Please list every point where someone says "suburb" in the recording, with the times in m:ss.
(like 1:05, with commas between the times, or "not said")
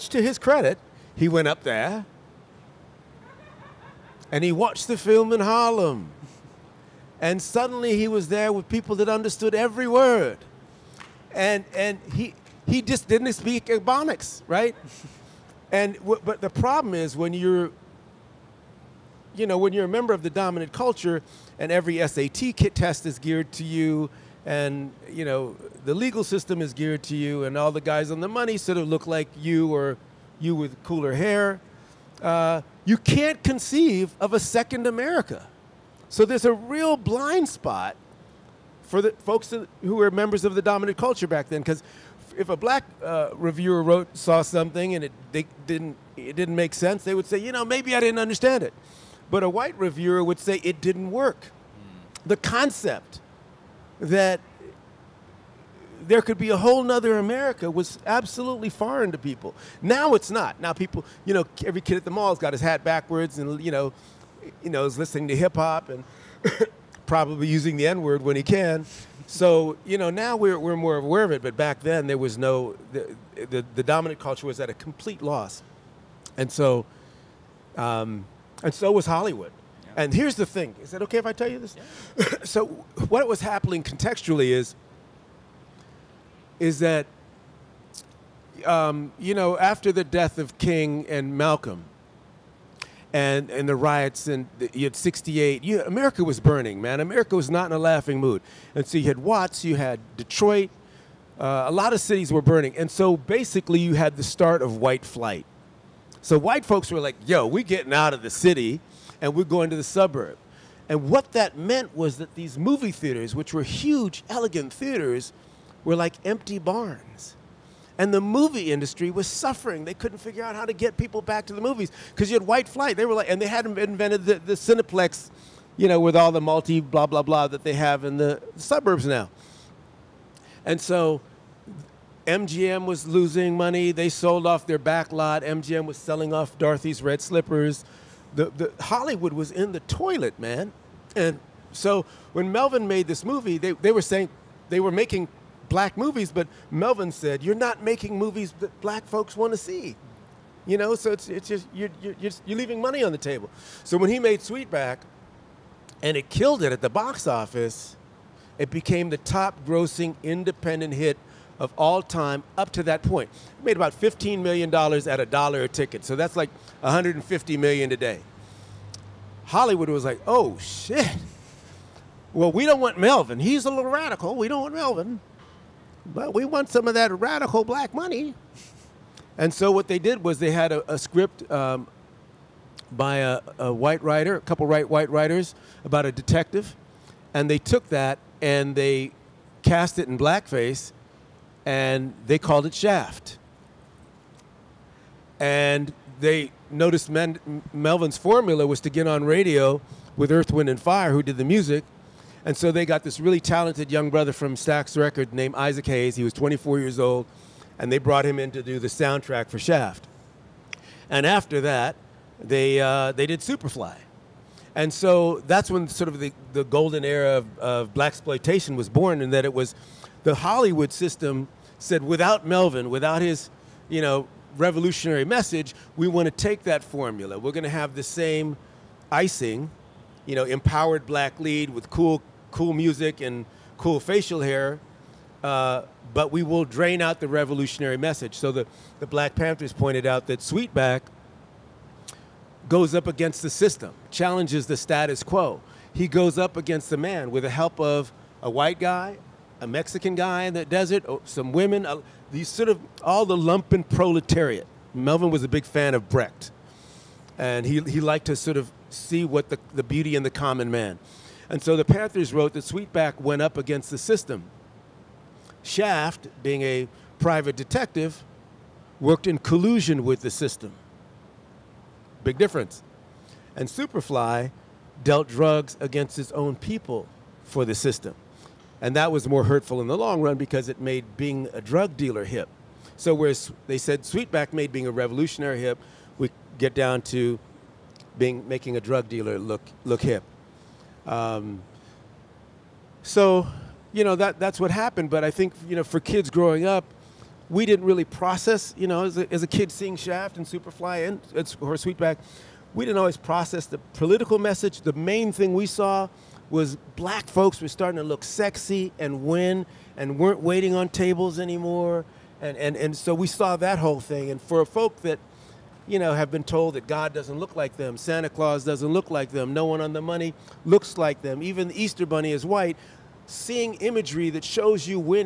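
1:49, 2:08.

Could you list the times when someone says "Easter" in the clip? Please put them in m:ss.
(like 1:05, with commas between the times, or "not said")
5:21.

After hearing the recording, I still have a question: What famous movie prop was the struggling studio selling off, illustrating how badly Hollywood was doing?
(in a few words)
Dorothy's Red Slippers.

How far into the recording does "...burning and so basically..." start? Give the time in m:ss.
1:42.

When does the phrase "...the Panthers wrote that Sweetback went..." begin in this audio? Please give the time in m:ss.
4:21.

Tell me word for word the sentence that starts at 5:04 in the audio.
The main thing we saw was black folks were starting to look sexy and win and weren't waiting on tables anymore.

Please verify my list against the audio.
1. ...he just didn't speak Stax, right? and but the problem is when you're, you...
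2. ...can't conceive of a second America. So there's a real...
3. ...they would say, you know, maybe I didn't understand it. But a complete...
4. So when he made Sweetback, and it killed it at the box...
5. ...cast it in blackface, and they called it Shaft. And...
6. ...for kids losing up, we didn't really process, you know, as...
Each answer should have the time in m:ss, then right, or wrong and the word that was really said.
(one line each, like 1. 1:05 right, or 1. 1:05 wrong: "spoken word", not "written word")
1. 0:12 wrong: "Ebonics", not "Stax"
2. 0:32 right
3. 0:47 wrong: "white", not "complete"
4. 2:33 right
5. 3:09 right
6. 4:55 wrong: "growing", not "losing".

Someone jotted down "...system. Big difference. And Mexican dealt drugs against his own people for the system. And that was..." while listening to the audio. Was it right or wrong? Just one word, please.
wrong.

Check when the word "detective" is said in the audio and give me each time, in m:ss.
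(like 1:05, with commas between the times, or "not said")
3:06, 4:27.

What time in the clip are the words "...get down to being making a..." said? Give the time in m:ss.
4:46.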